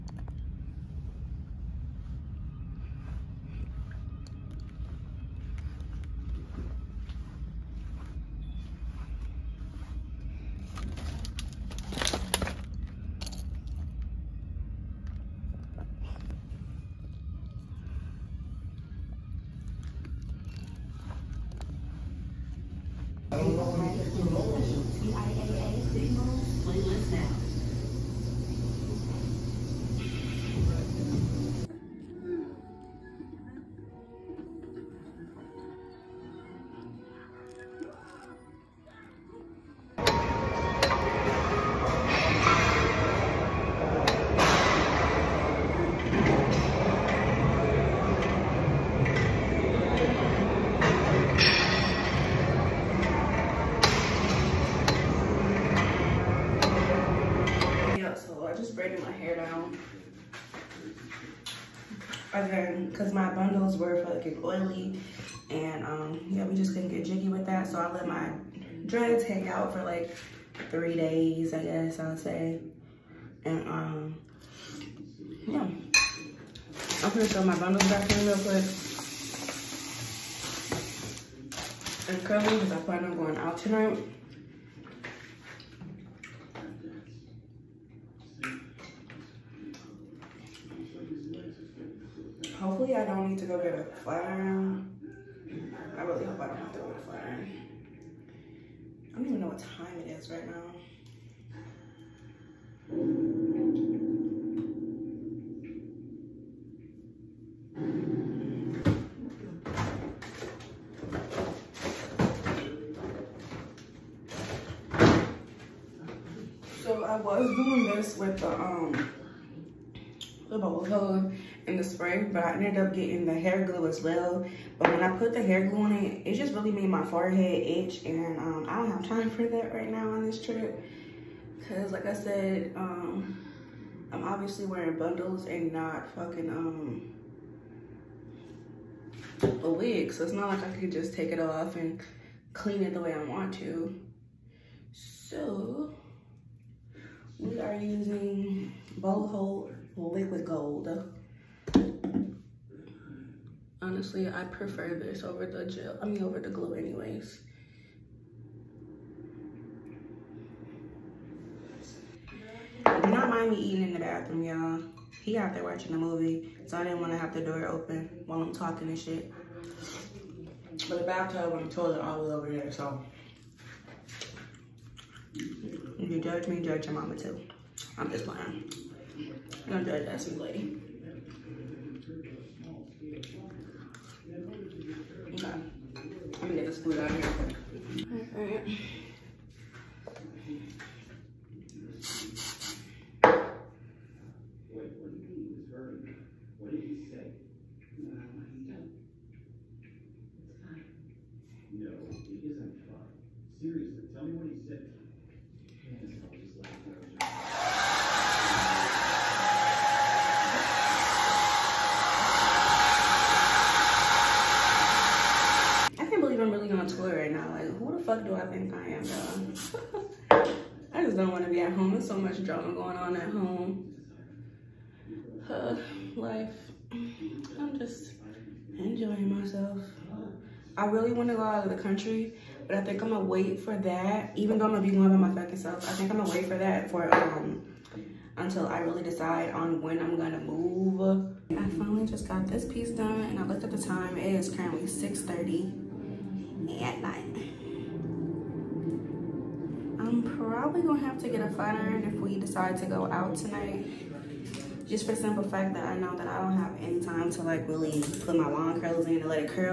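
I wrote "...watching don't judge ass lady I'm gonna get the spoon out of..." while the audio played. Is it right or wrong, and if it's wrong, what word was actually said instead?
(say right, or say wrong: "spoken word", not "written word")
wrong: "playing", not "watching".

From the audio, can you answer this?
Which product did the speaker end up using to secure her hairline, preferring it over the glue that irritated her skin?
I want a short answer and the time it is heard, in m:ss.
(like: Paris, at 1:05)
Liquid Gold, at 2:29.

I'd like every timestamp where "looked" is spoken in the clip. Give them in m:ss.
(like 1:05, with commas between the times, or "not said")
4:03.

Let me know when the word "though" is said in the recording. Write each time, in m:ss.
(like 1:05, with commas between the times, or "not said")
3:39, 3:54.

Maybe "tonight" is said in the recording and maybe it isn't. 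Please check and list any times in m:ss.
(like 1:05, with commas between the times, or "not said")
1:23, 4:13.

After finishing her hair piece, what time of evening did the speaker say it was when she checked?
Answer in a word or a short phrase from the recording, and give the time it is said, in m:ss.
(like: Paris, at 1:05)
6:30, at 4:04.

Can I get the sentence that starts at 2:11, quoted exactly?
Cause like I said, um, I'm obviously wearing bundles and not fucking um, a wig.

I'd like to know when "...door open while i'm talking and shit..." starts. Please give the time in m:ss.
2:47.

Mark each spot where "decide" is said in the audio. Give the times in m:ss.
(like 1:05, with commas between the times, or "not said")
3:59, 4:12.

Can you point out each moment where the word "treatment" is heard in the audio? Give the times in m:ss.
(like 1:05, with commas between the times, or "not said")
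not said.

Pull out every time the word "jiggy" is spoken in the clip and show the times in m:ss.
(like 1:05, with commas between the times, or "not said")
1:07.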